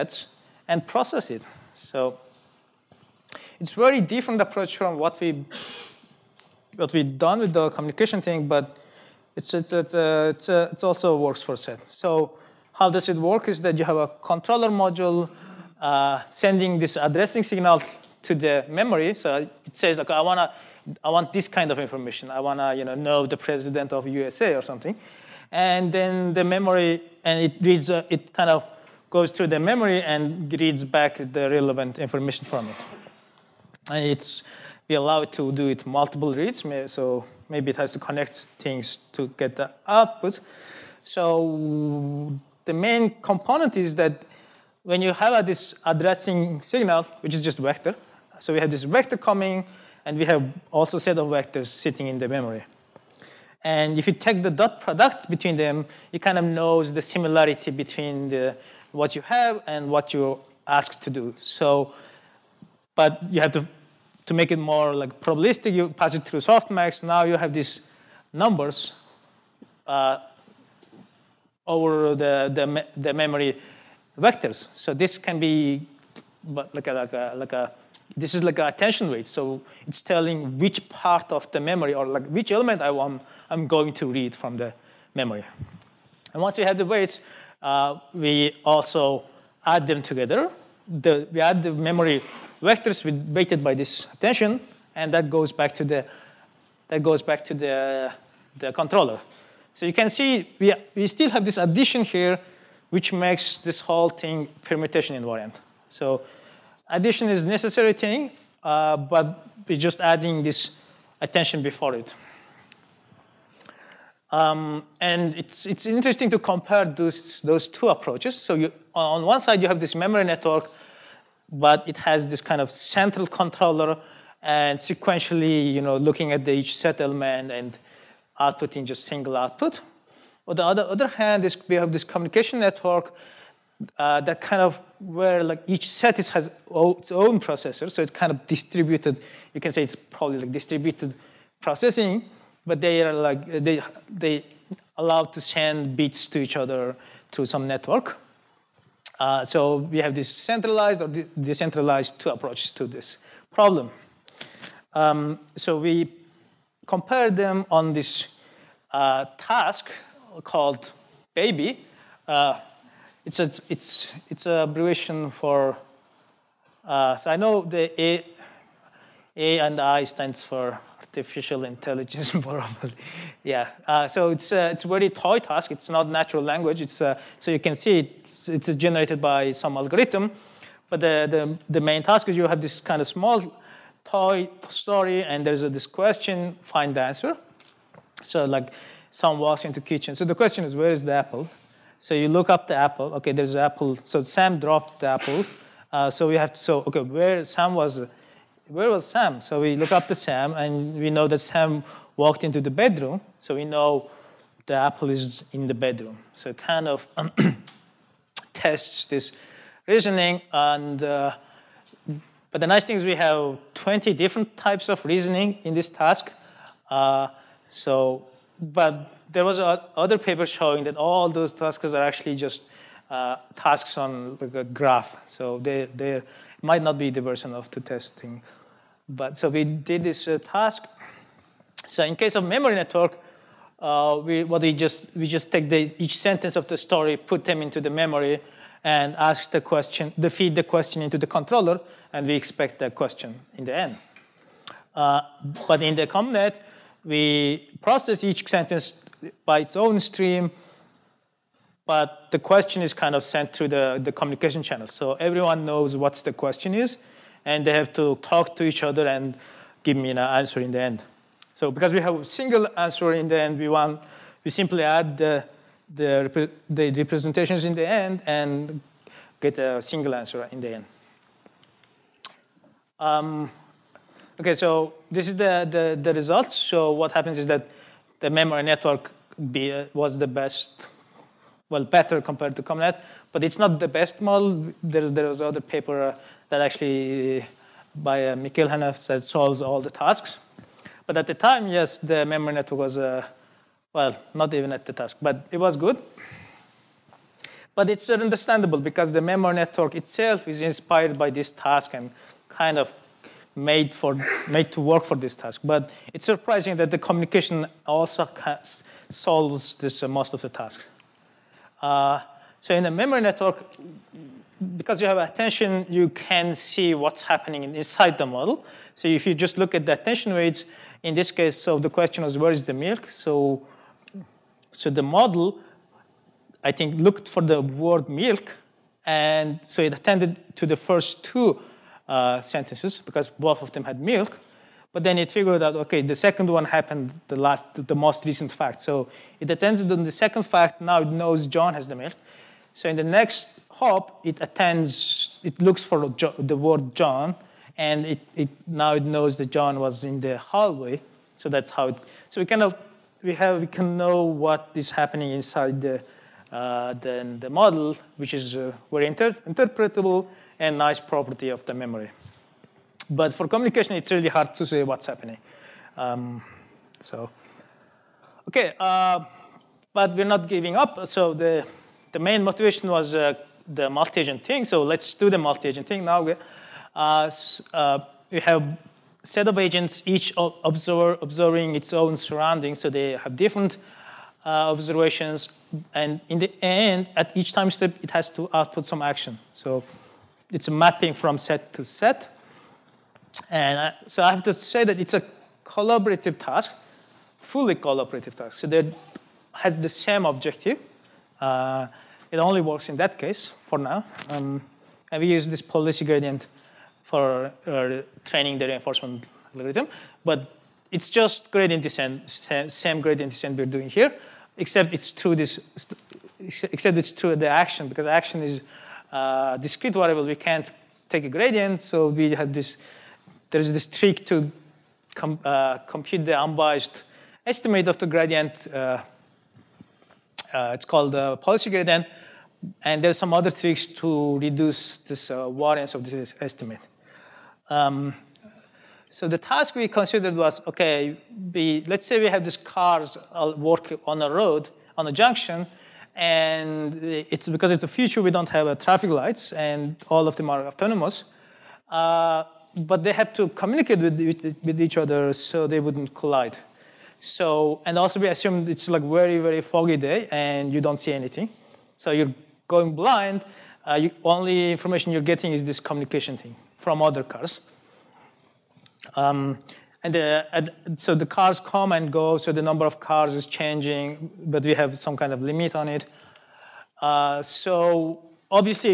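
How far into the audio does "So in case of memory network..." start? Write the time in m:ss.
3:51.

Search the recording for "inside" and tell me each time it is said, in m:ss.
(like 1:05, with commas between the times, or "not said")
5:17, 5:55.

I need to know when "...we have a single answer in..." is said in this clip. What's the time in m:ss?
4:21.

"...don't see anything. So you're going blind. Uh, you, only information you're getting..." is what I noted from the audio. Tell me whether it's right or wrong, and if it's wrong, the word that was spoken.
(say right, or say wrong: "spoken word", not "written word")
right.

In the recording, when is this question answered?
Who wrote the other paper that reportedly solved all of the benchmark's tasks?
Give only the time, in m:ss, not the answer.
4:48.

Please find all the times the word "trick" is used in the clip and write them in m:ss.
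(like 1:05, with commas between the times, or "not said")
7:03, 7:13.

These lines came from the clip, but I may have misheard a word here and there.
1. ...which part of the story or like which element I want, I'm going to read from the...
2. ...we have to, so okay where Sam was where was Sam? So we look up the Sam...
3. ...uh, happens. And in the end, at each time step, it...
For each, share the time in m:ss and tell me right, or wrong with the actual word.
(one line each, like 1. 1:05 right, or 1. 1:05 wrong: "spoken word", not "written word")
1. 1:20 wrong: "memory", not "story"
2. 3:16 right
3. 6:24 wrong: "observations", not "happens".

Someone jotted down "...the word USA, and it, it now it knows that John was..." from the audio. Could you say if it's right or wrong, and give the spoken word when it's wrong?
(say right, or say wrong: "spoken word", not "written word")
wrong: "John", not "USA".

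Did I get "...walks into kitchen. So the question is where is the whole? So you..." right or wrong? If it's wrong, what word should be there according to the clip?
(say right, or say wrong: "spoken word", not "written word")
wrong: "apple", not "whole".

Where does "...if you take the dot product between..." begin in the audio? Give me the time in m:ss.
0:53.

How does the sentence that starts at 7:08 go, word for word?
Uh, uh it's called the policy gradient.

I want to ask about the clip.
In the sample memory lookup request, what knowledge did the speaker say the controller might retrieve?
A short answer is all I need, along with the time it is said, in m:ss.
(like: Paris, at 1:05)
the president of USA, at 0:23.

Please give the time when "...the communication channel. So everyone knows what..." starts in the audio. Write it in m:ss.
4:14.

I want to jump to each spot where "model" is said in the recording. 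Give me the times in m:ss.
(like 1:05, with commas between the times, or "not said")
4:44, 5:18, 5:25, 5:57.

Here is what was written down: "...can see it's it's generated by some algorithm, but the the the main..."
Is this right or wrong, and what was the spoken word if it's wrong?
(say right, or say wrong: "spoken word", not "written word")
right.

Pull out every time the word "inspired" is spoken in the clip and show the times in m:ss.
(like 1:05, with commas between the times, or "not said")
5:00.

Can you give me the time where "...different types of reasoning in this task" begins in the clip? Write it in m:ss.
3:34.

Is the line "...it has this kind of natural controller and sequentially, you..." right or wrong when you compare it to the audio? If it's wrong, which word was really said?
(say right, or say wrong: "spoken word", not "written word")
wrong: "central", not "natural".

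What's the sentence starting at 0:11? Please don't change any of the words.
So how does it work is that you have a controller module uh, sending this addressing signal to the memory.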